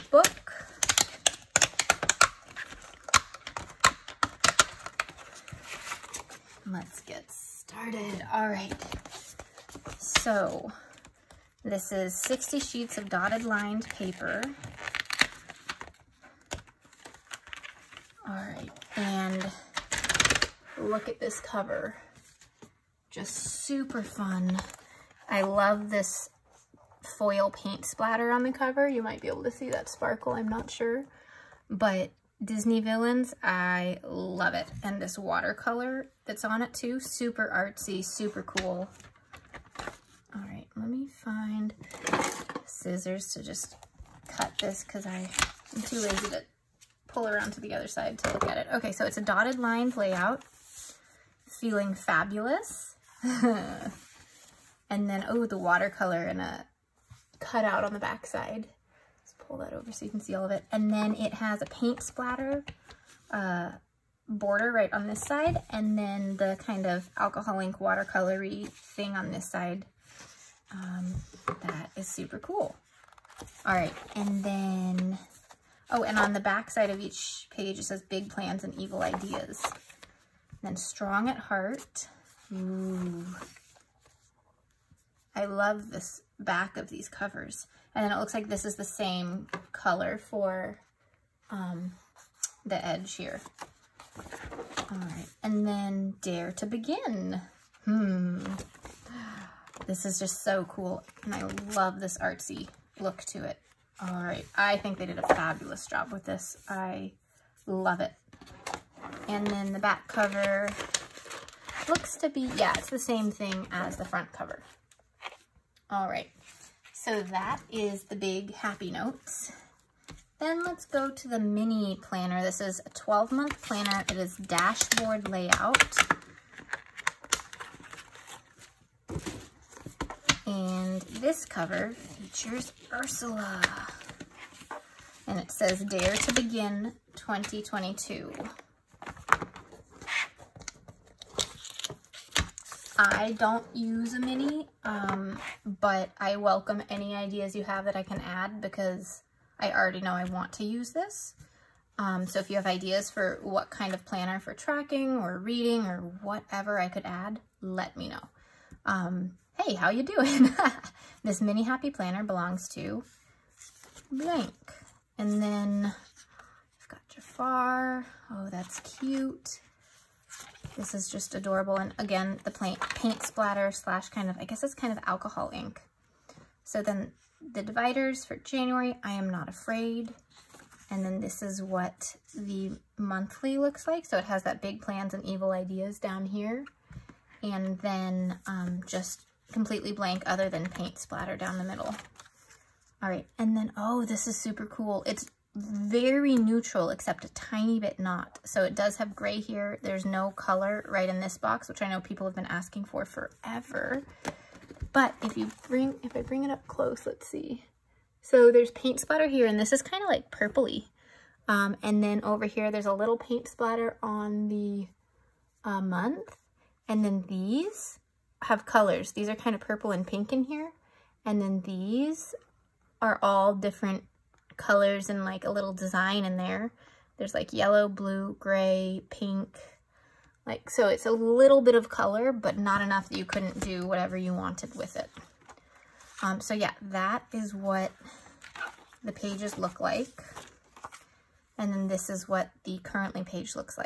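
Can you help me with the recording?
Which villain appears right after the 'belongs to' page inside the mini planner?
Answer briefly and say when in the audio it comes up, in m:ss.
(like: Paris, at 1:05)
Jafar, at 2:47.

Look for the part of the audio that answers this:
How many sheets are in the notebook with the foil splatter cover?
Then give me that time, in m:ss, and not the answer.
0:12.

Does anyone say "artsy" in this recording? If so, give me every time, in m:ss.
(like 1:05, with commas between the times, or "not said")
0:37, 1:42.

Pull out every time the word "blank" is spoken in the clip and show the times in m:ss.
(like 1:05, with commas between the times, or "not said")
2:44, 3:09.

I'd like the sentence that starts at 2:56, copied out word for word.
So then the dividers for January, I am not afraid.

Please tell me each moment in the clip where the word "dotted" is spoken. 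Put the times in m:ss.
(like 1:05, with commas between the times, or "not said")
0:13, 0:49.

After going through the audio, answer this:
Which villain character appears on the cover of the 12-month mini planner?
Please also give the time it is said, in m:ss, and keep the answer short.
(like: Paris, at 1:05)
Ursula, at 2:12.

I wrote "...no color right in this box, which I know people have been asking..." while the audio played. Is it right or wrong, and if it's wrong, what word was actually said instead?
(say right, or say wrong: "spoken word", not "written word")
right.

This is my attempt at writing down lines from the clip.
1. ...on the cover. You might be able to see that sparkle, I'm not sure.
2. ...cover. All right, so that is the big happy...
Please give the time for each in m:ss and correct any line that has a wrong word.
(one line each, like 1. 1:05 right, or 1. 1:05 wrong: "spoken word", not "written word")
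1. 0:28 right
2. 1:54 right.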